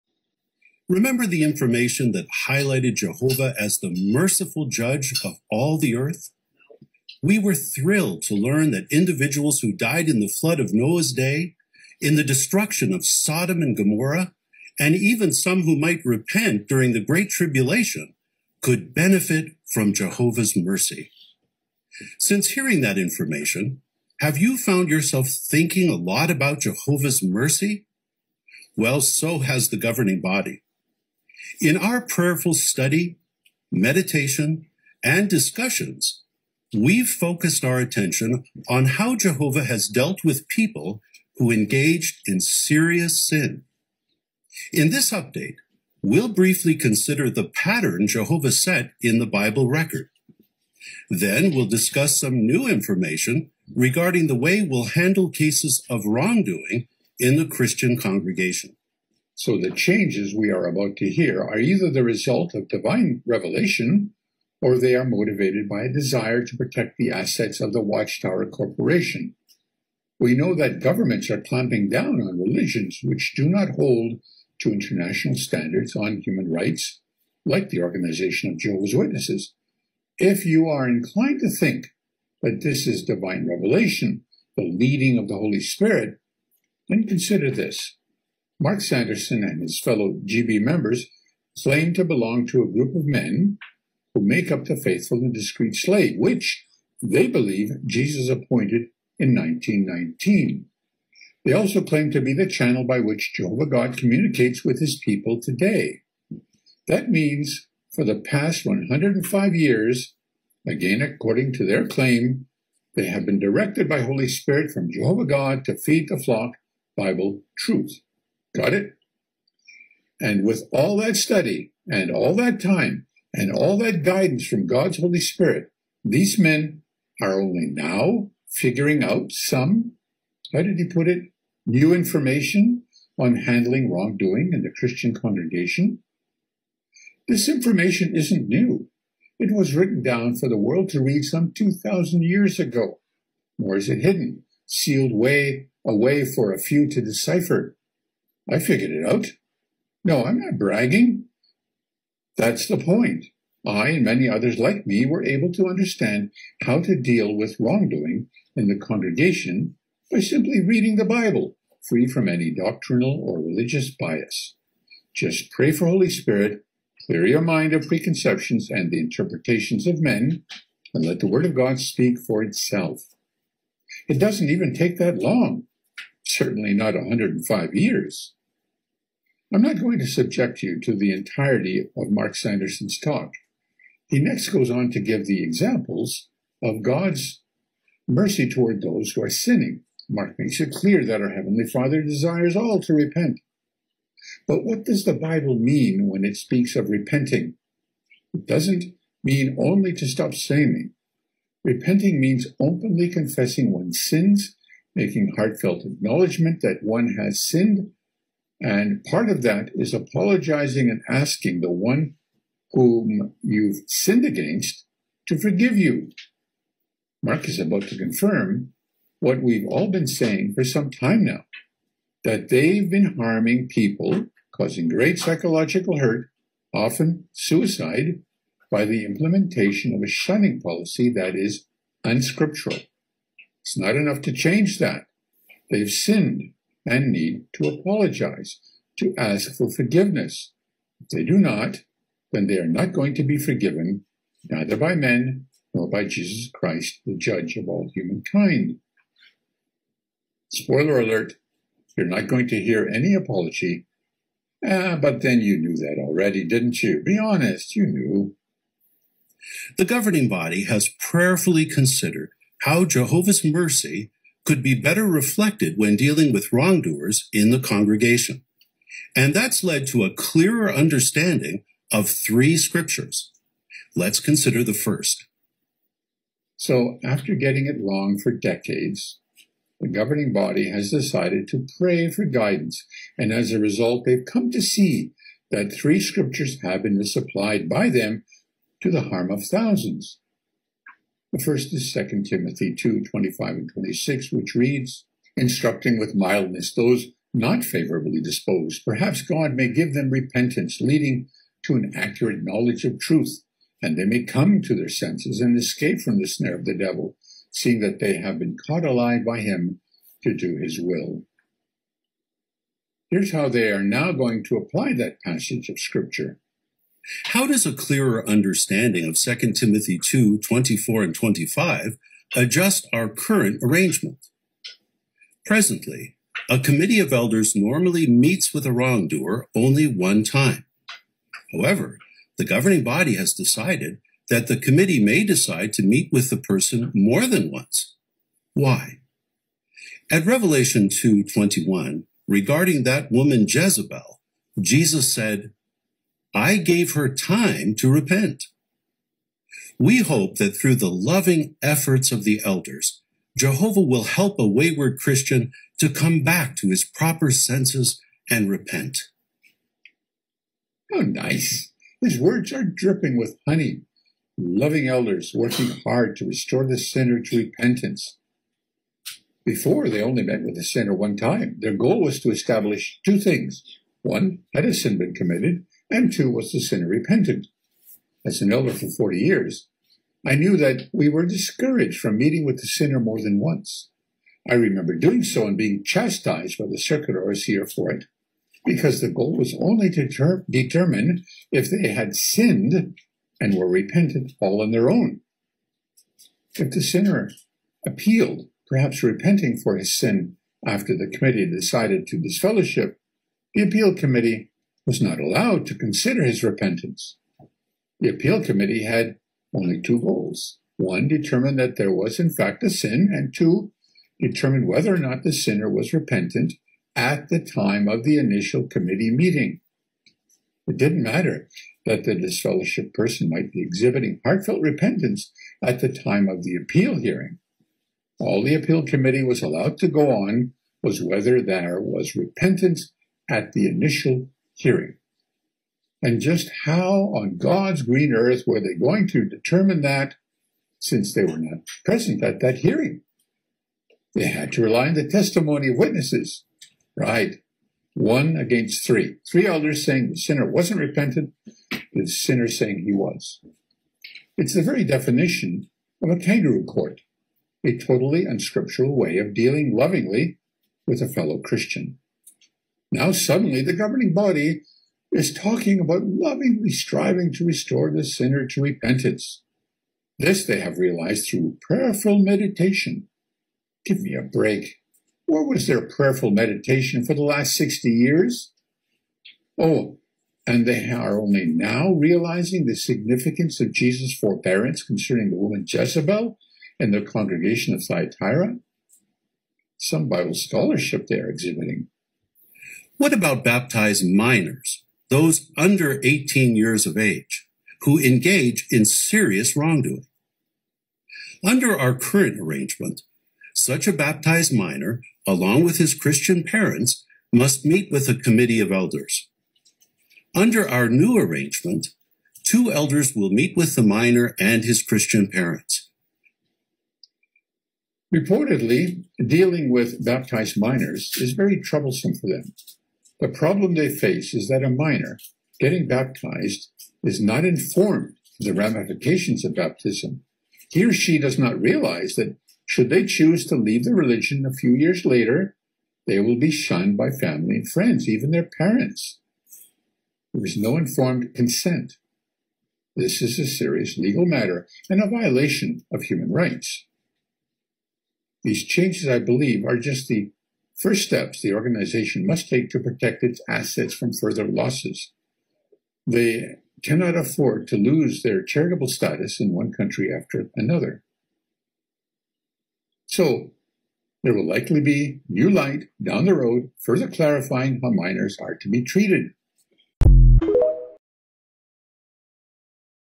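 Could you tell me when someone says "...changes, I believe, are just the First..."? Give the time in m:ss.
9:08.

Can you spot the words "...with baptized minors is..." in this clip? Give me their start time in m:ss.
8:39.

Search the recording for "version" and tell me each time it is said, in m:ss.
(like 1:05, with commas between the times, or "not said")
not said.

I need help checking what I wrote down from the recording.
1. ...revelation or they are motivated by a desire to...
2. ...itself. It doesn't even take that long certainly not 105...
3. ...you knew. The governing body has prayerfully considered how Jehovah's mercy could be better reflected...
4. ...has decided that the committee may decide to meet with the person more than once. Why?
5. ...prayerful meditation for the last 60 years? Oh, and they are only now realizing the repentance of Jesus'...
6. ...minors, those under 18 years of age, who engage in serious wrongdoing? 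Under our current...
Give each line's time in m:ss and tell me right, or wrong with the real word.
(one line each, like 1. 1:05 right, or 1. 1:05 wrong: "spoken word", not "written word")
1. 1:03 right
2. 2:52 right
3. 4:17 right
4. 5:33 right
5. 7:55 wrong: "significance", not "repentance"
6. 8:14 right.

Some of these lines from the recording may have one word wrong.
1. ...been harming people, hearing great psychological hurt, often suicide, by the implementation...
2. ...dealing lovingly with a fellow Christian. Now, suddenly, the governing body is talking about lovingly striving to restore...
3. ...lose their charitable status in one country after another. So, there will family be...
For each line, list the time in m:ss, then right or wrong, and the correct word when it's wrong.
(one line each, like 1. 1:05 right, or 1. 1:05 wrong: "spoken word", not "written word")
1. 3:42 wrong: "causing", not "hearing"
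2. 7:39 right
3. 9:17 wrong: "likely", not "family".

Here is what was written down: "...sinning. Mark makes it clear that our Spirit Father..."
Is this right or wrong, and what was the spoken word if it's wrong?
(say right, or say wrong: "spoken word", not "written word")
wrong: "Heavenly", not "Spirit".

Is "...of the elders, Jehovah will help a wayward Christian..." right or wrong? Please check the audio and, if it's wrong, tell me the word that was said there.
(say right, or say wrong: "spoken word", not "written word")
right.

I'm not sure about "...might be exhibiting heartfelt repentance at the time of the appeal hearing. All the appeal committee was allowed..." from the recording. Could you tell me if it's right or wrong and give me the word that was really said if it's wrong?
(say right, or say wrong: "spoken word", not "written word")
right.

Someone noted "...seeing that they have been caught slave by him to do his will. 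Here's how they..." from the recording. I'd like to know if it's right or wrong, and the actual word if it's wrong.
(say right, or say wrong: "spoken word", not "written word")
wrong: "alive", not "slave".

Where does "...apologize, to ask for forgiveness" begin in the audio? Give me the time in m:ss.
3:57.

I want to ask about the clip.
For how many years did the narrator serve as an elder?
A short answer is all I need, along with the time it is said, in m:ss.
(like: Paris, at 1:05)
40, at 6:18.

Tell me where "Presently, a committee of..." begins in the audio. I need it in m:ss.
5:25.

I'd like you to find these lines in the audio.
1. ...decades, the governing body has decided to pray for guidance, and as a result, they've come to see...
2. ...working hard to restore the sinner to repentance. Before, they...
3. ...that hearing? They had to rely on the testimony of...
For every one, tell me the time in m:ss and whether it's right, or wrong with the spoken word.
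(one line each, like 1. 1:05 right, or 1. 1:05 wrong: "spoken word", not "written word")
1. 4:38 right
2. 6:05 right
3. 7:22 right.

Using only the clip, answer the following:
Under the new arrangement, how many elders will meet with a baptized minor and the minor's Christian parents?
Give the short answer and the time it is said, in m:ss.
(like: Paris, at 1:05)
2, at 8:32.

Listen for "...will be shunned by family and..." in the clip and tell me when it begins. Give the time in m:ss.
8:56.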